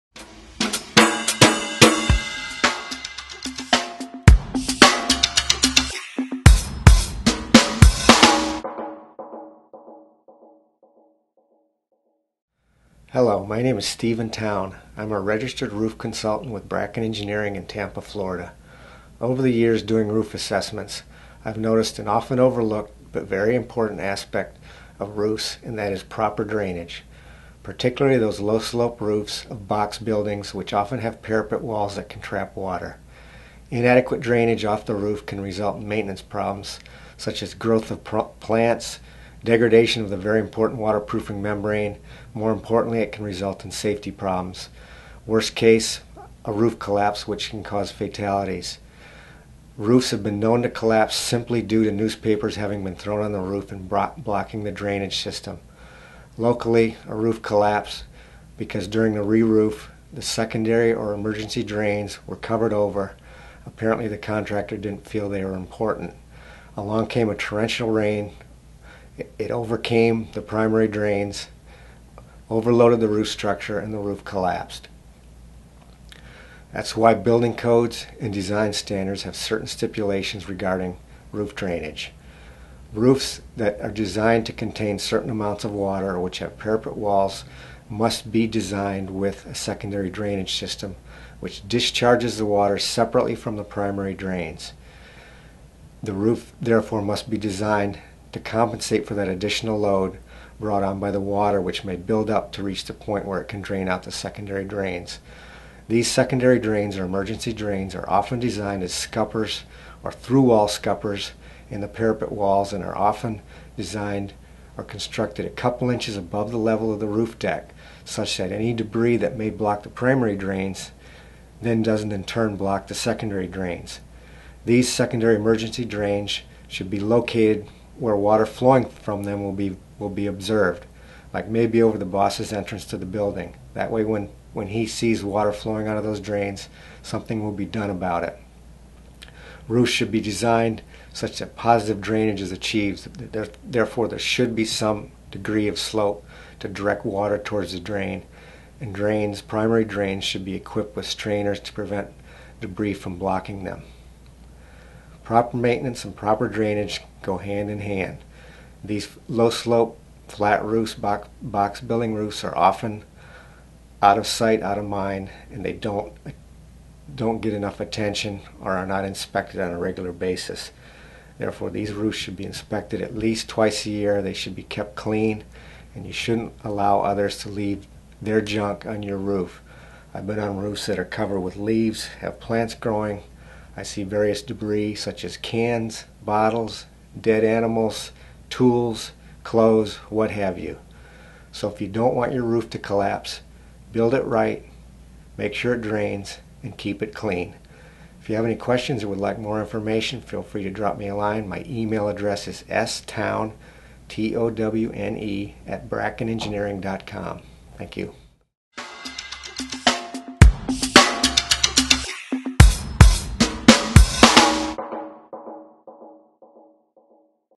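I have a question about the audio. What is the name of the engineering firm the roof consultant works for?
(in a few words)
Bracken Engineering.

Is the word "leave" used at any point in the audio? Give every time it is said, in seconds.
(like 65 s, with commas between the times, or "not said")
177 s, 181 s.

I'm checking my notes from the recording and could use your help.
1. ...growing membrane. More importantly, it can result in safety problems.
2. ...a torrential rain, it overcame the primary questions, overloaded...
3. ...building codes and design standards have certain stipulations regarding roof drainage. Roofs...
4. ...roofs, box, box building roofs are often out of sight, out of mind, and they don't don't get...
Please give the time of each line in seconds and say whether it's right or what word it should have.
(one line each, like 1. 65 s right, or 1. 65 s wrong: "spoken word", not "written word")
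1. 40 s wrong: "waterproofing", not "growing"
2. 67 s wrong: "drains", not "questions"
3. 77 s right
4. 160 s right.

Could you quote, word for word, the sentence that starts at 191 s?
So if you don't want your roof to collapse, build it right, make sure it drains, and keep it clean.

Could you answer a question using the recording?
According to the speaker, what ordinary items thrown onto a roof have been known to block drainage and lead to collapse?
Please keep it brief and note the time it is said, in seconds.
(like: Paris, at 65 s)
Newspapers, at 51 s.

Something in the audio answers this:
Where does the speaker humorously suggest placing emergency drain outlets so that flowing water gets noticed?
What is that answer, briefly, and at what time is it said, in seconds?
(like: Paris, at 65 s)
Over the boss's entrance, at 131 s.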